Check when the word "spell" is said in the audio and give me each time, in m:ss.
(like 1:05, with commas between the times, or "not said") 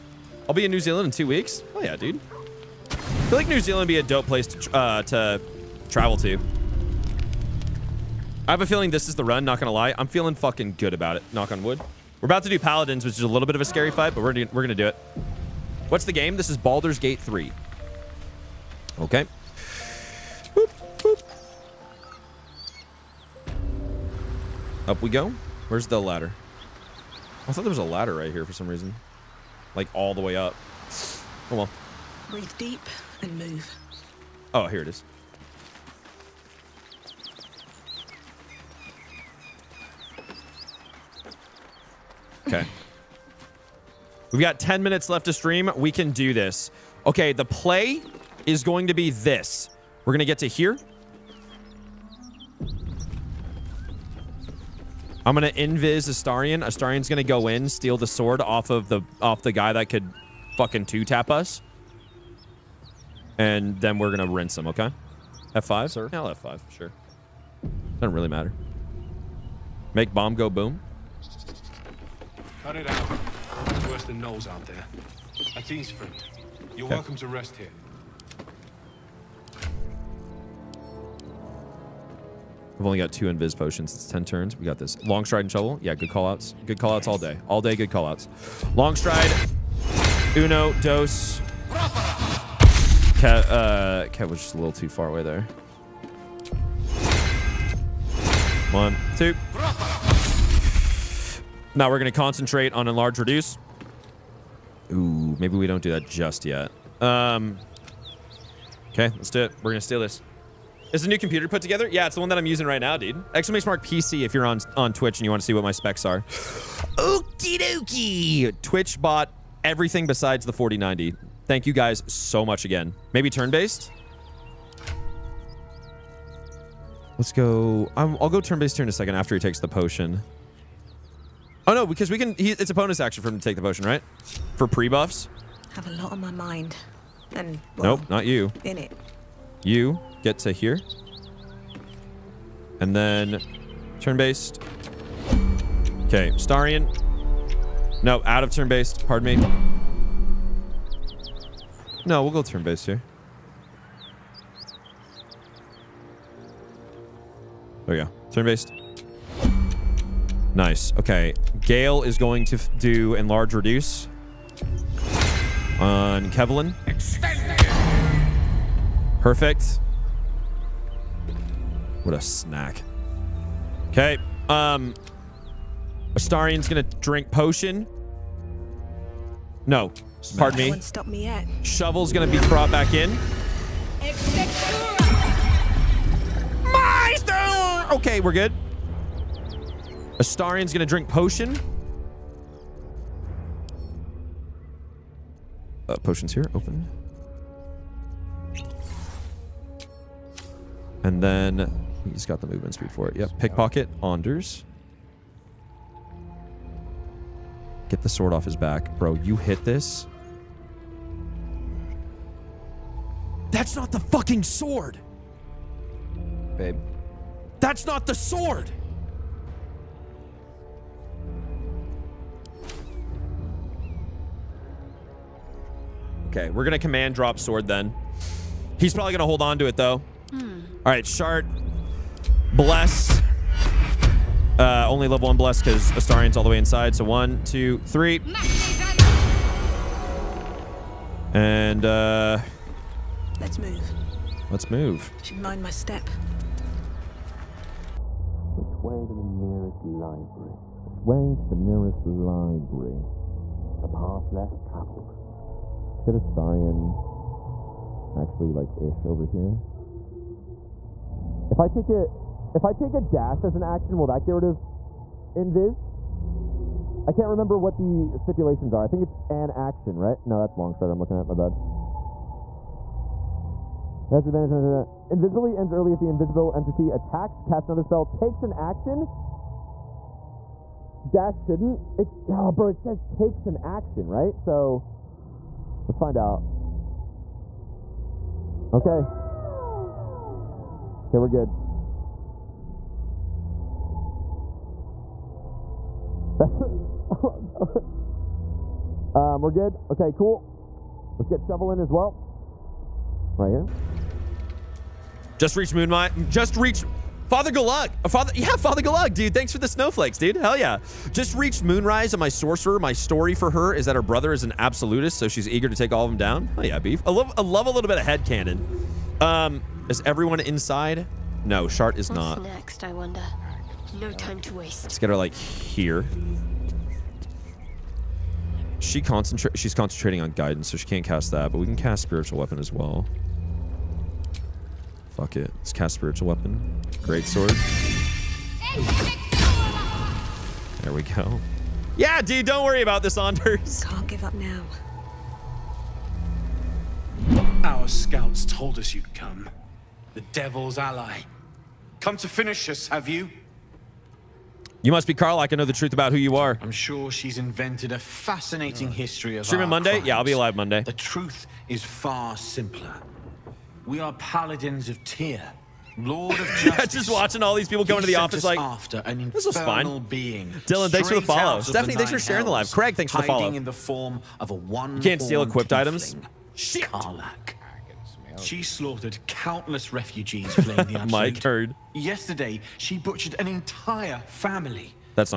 4:37.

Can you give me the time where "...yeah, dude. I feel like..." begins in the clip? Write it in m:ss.
0:01.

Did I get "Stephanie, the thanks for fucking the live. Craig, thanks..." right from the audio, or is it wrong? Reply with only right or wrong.
wrong.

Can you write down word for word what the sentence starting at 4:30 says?
No, that's long strider I'm looking at.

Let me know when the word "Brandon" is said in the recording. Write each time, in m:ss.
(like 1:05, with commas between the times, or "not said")
not said.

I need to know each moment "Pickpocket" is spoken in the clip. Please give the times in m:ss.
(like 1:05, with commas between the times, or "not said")
3:23.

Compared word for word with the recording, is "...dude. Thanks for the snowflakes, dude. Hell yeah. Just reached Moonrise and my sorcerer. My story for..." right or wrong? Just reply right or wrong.
right.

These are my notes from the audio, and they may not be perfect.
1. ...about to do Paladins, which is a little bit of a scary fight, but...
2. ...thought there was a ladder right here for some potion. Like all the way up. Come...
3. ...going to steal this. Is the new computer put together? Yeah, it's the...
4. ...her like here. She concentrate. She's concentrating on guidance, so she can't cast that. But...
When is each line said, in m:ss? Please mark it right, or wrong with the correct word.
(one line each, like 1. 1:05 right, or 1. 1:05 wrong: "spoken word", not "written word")
1. 0:12 right
2. 0:27 wrong: "reason", not "potion"
3. 1:49 right
4. 5:25 right.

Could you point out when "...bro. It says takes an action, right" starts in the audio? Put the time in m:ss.
4:42.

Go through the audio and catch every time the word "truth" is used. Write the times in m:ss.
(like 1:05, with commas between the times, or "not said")
5:55, 6:00.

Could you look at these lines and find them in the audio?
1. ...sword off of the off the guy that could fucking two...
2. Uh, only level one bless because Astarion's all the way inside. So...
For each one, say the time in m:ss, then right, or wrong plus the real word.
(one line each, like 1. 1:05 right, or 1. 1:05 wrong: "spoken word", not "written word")
1. 0:58 right
2. 3:54 right.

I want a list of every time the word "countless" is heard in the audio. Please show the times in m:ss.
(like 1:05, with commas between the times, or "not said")
6:19.